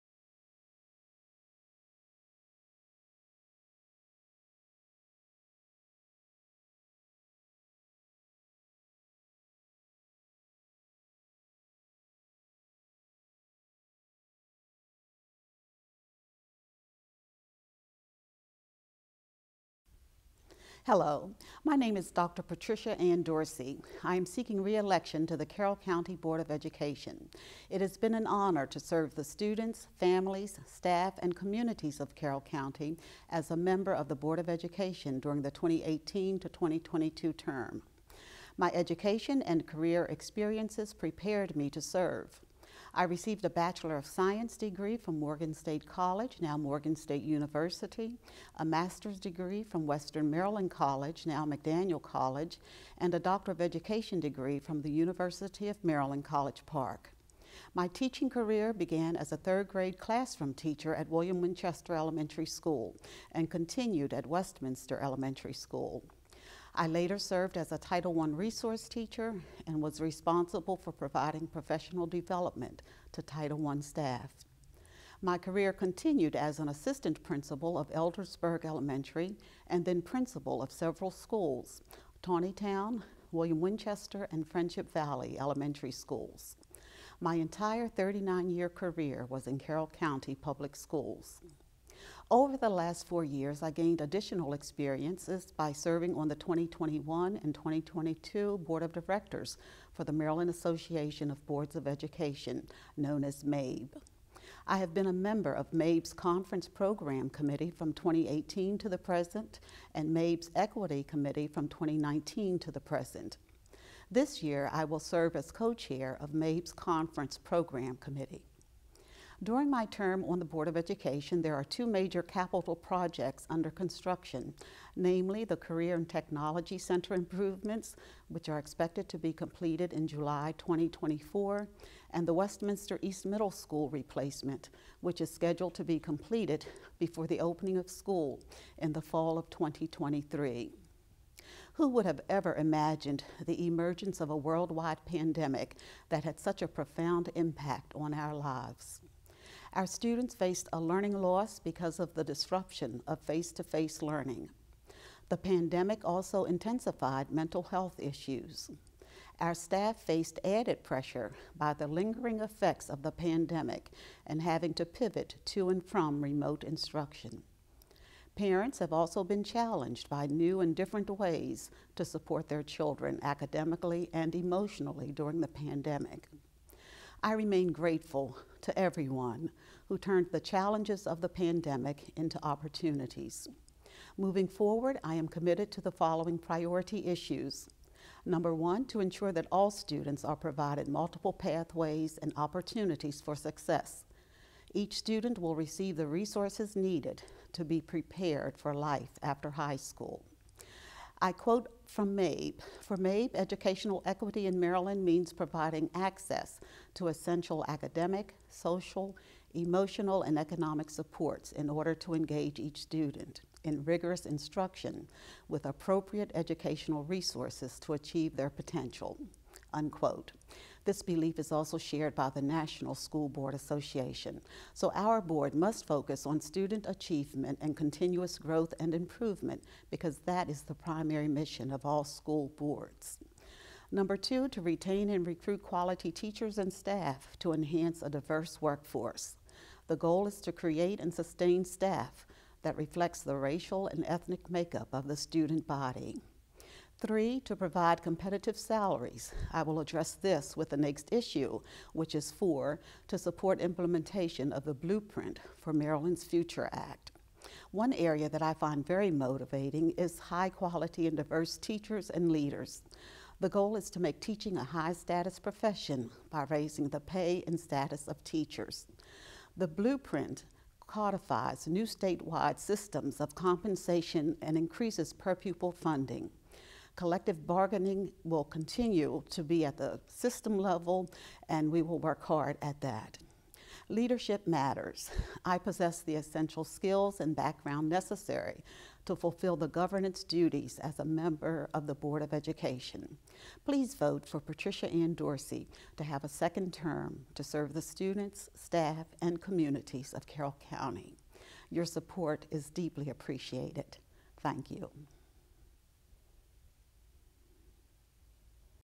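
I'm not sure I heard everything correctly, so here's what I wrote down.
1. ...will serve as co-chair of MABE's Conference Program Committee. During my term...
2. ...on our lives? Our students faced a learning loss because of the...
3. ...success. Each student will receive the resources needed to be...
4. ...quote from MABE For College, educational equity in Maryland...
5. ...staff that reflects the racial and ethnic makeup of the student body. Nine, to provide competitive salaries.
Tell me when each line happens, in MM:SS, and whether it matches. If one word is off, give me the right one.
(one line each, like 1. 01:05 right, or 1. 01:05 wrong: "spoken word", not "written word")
1. 01:54 right
2. 02:27 right
3. 03:13 right
4. 03:21 wrong: "MABE", not "College"
5. 04:01 wrong: "Three", not "Nine".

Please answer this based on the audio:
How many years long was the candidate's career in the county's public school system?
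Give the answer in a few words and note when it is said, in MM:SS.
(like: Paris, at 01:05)
39, at 01:27.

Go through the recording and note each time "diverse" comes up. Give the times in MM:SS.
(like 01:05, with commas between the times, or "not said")
03:58, 04:21.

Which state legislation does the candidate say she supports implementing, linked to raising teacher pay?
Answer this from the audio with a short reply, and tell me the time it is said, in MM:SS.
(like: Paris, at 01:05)
Blueprint for Maryland's Future Act, at 04:14.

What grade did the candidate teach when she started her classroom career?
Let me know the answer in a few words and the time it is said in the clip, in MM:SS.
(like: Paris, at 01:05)
Third grade, at 00:59.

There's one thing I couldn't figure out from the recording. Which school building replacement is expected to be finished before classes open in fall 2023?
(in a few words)
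Westminster East Middle School.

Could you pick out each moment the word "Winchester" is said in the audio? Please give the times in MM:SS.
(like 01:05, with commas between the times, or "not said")
01:01, 01:23.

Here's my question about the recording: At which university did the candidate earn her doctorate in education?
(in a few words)
University of Maryland College Park.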